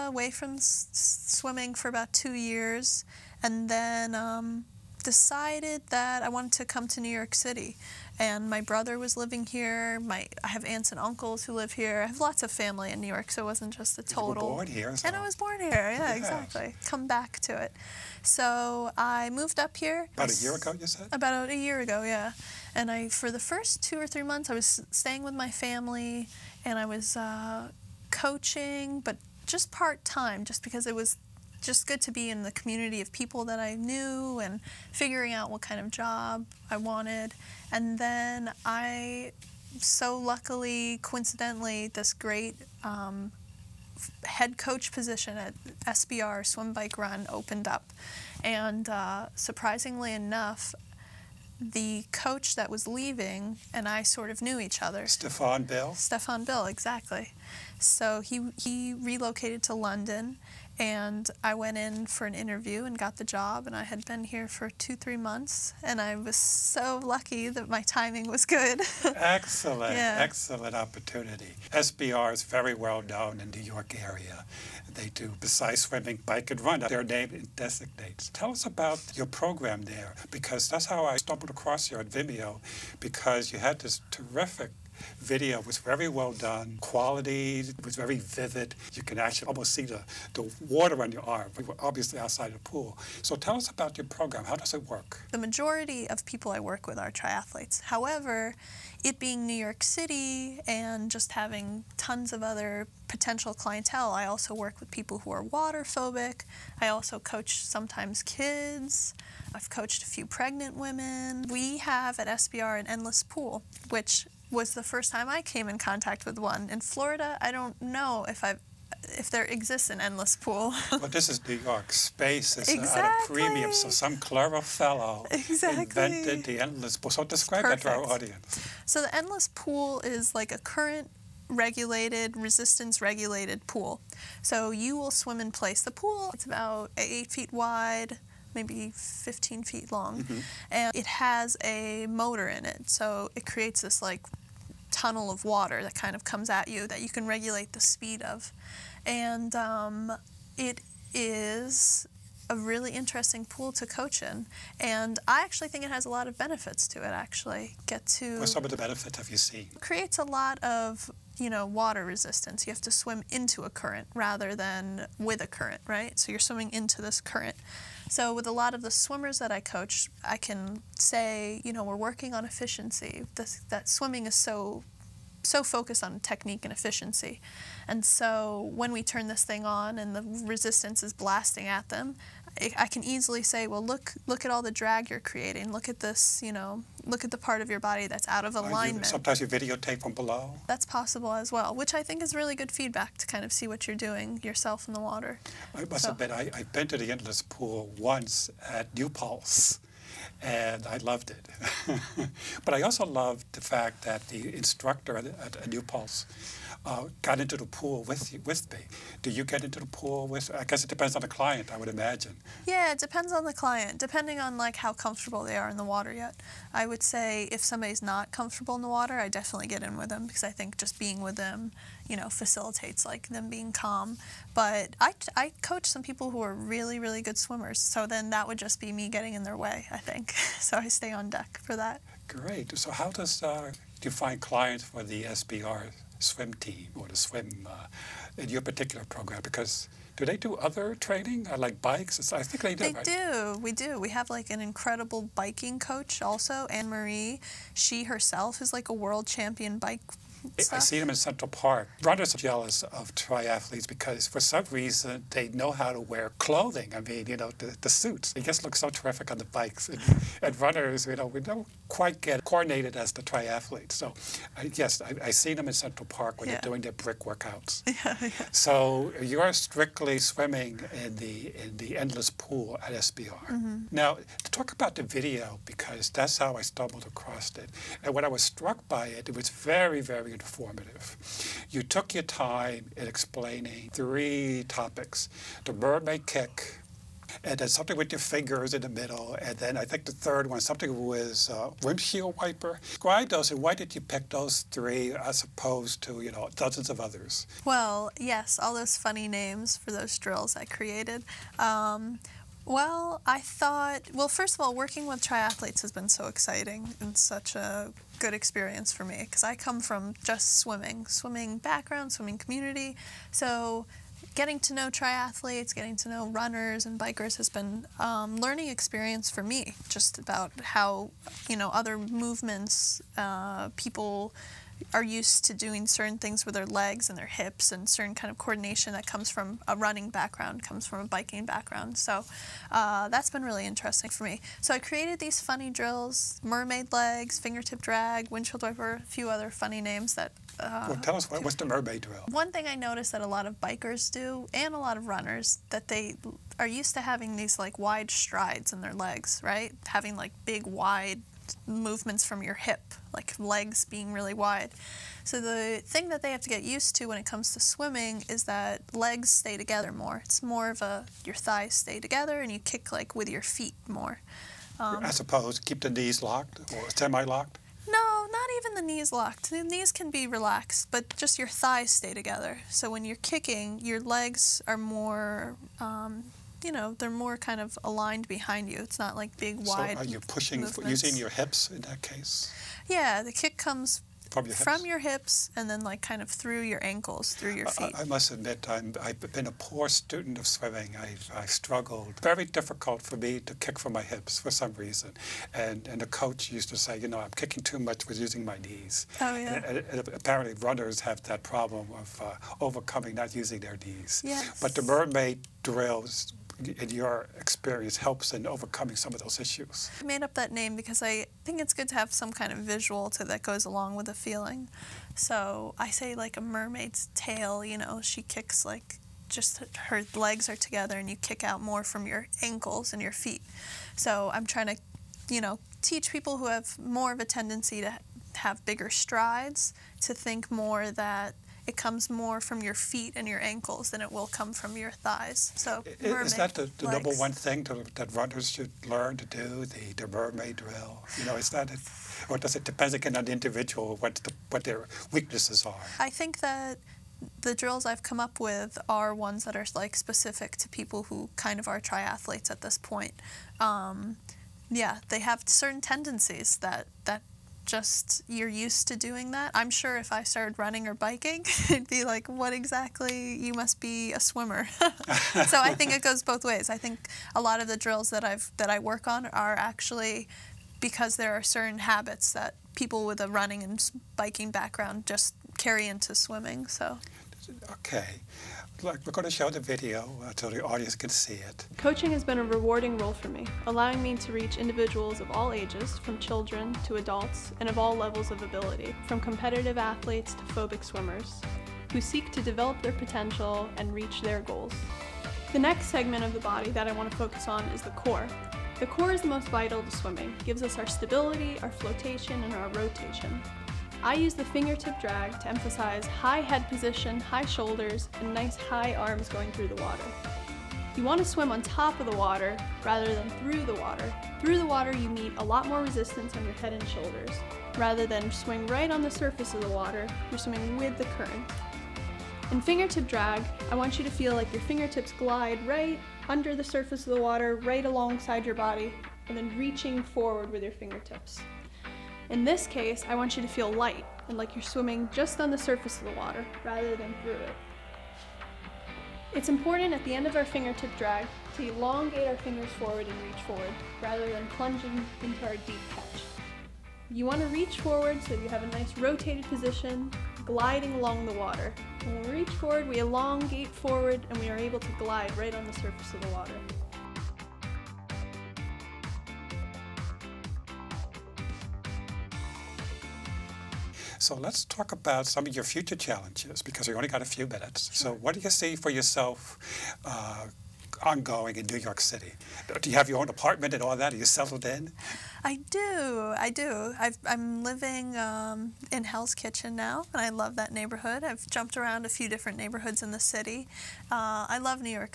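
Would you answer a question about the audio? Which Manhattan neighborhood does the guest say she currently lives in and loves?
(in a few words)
Hell's Kitchen.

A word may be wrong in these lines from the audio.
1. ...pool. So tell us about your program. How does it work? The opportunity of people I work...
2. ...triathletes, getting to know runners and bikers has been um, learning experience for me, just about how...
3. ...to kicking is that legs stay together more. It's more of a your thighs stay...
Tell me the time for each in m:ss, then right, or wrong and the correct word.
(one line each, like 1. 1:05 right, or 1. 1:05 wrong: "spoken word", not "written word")
1. 1:32 wrong: "majority", not "opportunity"
2. 5:14 right
3. 5:57 wrong: "swimming", not "kicking".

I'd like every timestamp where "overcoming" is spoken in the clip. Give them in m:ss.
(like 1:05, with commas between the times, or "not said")
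6:42, 6:48.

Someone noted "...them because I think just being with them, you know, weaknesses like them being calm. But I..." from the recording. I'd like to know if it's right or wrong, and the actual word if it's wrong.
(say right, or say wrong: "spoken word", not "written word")
wrong: "facilitates", not "weaknesses".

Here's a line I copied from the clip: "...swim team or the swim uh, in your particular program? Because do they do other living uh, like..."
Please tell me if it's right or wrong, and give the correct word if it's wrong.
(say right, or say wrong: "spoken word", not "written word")
wrong: "training", not "living".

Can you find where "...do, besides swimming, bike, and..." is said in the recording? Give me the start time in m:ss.
1:15.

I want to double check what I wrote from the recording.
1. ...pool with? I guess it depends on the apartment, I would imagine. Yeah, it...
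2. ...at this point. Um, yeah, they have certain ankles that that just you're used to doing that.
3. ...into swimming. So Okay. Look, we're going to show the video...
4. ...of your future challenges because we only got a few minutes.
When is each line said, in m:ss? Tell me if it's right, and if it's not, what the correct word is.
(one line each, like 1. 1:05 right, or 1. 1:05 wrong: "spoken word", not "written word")
1. 3:29 wrong: "client", not "apartment"
2. 7:32 wrong: "tendencies", not "ankles"
3. 7:55 right
4. 9:25 right.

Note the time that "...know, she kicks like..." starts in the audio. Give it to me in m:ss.
6:57.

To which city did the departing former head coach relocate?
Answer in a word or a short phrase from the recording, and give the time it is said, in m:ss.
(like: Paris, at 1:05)
London, at 0:59.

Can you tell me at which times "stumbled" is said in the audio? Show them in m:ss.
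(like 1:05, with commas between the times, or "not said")
1:21, 4:36.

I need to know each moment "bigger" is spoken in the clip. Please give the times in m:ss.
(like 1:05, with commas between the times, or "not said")
7:08.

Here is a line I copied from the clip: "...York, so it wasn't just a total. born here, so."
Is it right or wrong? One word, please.
right.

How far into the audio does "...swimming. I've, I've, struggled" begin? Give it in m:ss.
6:30.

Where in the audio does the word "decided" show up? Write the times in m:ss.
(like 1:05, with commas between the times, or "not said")
0:05.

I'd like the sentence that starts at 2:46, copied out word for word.
So you're swimming into this current.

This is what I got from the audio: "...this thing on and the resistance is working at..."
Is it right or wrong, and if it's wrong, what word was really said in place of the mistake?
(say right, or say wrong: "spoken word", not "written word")
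wrong: "blasting", not "working".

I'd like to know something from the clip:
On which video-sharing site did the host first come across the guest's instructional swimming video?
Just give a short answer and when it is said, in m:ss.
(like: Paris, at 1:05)
Vimeo, at 1:22.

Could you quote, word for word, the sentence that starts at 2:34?
And I actually think it has a lot of benefits to it, actually.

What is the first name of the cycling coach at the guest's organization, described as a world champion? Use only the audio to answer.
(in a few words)
Anne Marie.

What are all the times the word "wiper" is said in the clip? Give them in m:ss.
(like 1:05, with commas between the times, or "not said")
4:52, 5:38.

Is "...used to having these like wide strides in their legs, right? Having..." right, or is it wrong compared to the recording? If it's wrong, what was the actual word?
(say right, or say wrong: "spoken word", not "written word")
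right.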